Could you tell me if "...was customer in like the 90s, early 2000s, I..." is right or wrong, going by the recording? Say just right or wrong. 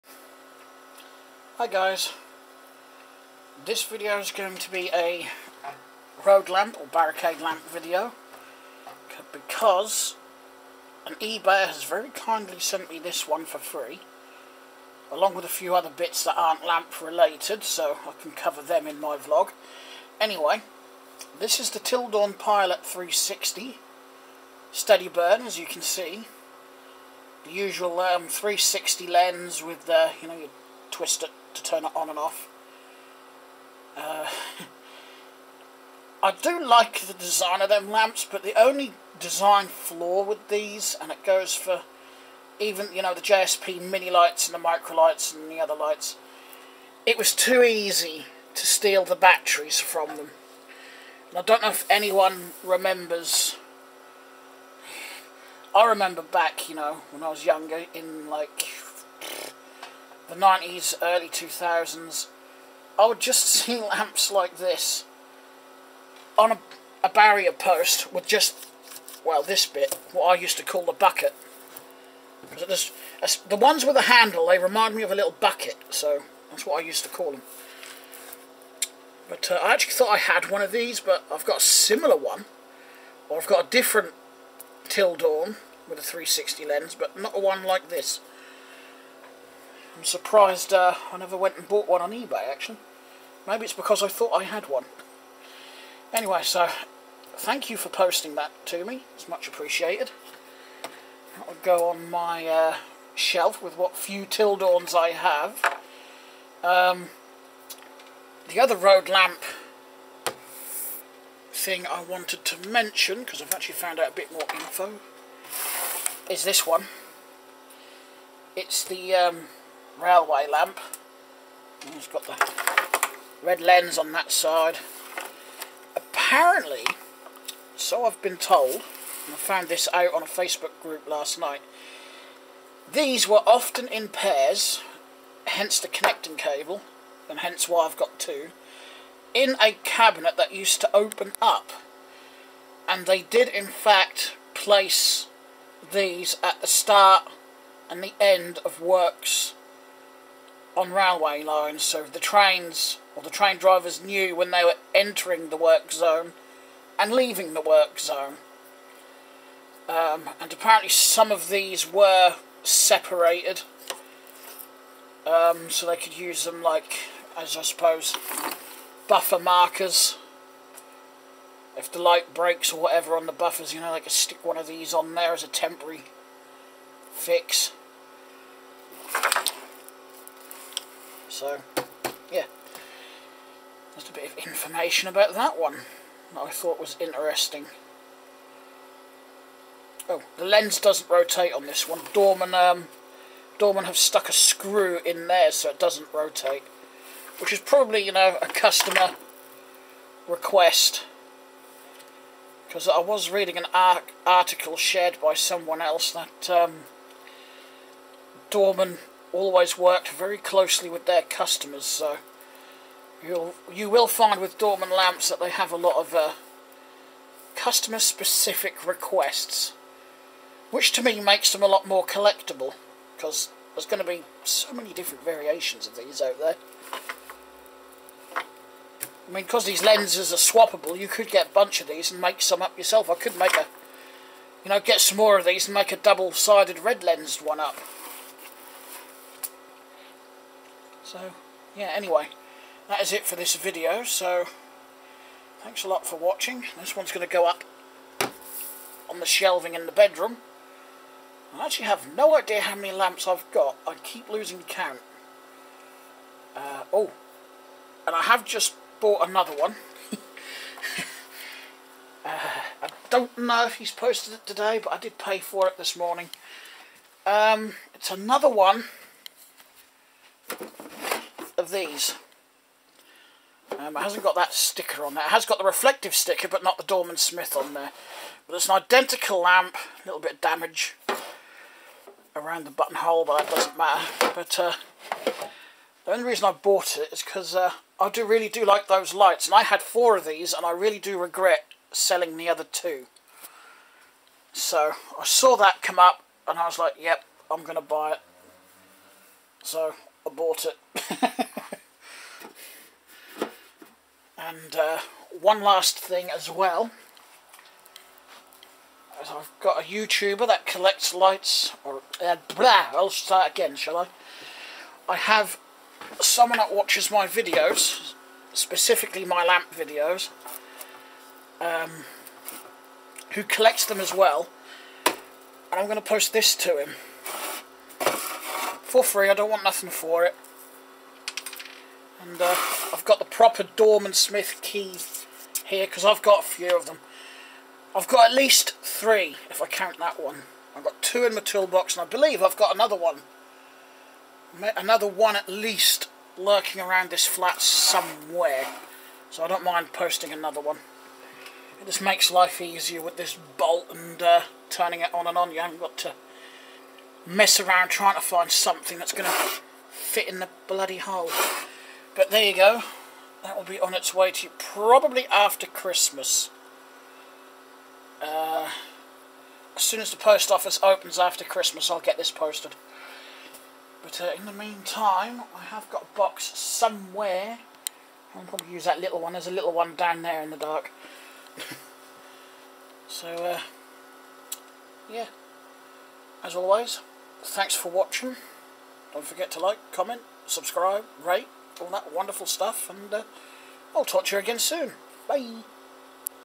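wrong.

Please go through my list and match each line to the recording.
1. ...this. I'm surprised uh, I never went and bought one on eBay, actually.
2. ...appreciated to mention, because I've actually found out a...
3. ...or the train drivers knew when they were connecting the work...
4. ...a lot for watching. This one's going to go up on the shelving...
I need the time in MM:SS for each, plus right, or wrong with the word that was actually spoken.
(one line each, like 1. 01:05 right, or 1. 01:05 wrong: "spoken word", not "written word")
1. 01:27 right
2. 01:52 wrong: "wanted", not "appreciated"
3. 02:33 wrong: "entering", not "connecting"
4. 04:05 right.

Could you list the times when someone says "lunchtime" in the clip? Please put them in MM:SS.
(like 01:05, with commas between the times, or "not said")
not said.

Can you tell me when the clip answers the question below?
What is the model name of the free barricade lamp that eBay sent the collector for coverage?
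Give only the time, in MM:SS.
00:21.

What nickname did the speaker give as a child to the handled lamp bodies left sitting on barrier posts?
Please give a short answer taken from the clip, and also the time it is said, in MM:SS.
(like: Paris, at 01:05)
the bucket, at 01:10.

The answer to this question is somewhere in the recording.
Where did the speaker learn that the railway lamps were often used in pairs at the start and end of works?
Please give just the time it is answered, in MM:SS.
02:10.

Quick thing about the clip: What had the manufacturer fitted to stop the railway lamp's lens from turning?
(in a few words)
a screw.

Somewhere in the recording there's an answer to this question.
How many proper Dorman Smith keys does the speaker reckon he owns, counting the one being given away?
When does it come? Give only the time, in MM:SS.
05:38.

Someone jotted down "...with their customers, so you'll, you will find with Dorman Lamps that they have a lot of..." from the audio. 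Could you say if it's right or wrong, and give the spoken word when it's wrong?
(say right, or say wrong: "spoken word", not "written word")
right.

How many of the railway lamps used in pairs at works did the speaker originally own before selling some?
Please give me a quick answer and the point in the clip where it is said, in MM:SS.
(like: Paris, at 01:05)
4, at 04:49.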